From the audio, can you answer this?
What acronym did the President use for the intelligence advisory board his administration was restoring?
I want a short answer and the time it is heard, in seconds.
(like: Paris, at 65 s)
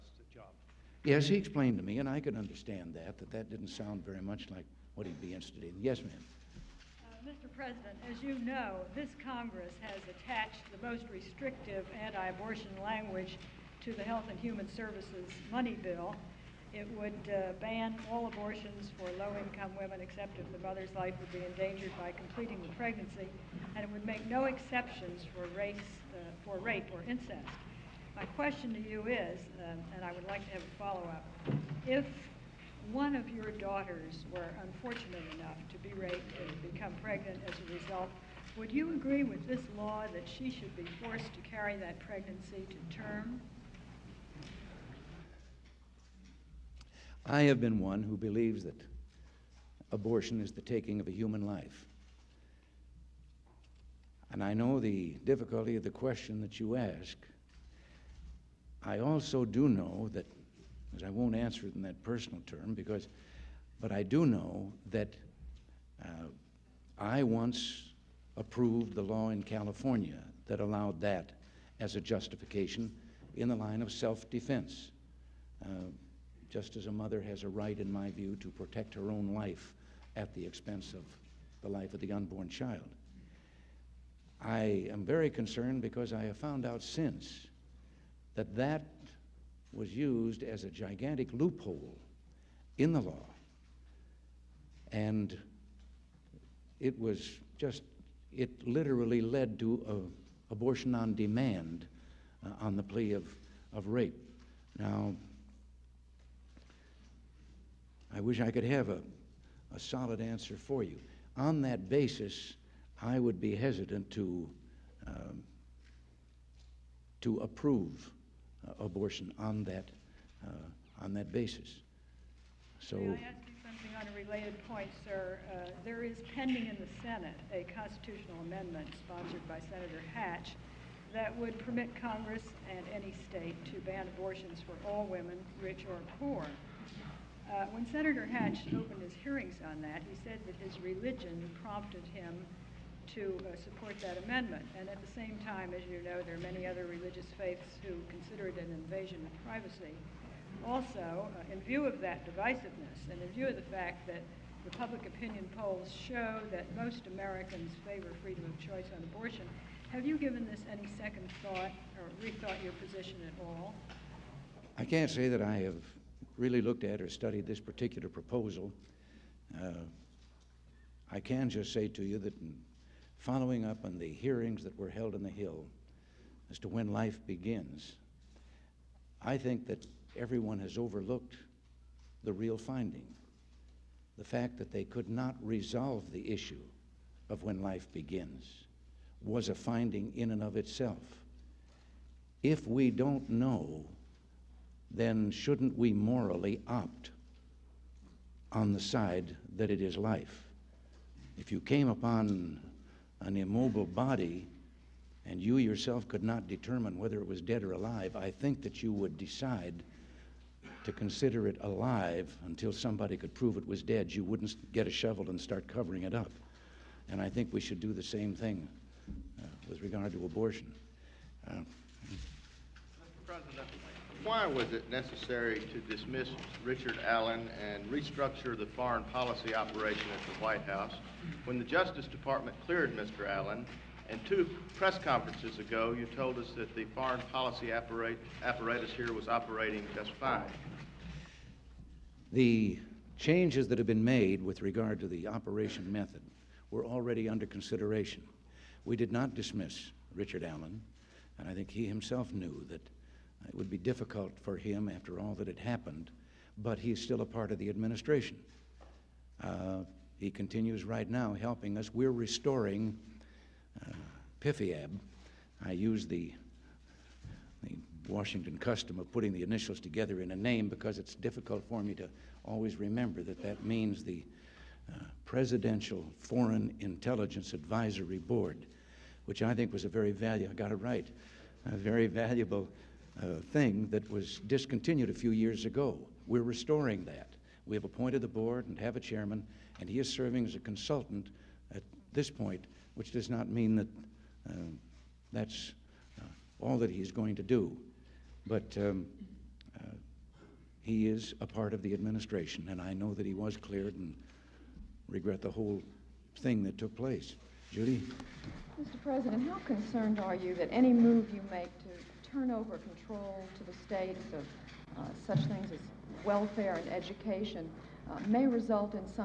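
PIFIAB, at 264 s.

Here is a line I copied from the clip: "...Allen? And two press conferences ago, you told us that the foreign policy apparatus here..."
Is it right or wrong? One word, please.
right.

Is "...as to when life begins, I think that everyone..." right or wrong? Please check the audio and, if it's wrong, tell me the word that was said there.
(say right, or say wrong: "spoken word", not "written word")
right.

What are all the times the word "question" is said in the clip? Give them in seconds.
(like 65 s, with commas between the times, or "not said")
28 s, 55 s.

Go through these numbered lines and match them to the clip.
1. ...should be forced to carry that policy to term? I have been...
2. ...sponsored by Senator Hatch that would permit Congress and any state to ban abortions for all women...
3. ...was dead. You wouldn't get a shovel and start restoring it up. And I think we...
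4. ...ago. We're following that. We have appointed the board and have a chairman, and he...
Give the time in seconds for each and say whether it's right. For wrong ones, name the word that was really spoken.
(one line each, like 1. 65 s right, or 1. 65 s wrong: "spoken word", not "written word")
1. 40 s wrong: "pregnancy", not "policy"
2. 129 s right
3. 213 s wrong: "covering", not "restoring"
4. 285 s wrong: "restoring", not "following".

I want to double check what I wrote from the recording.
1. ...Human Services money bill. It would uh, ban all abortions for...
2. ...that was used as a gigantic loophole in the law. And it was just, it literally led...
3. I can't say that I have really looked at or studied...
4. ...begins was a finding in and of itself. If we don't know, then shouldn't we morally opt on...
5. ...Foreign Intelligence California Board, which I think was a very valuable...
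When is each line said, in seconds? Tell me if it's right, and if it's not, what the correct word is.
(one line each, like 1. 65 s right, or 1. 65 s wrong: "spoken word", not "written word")
1. 14 s right
2. 88 s right
3. 164 s right
4. 187 s right
5. 276 s wrong: "Advisory", not "California".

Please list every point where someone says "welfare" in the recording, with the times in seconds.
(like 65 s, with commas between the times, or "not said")
316 s.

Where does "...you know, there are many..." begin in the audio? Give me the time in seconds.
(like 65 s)
145 s.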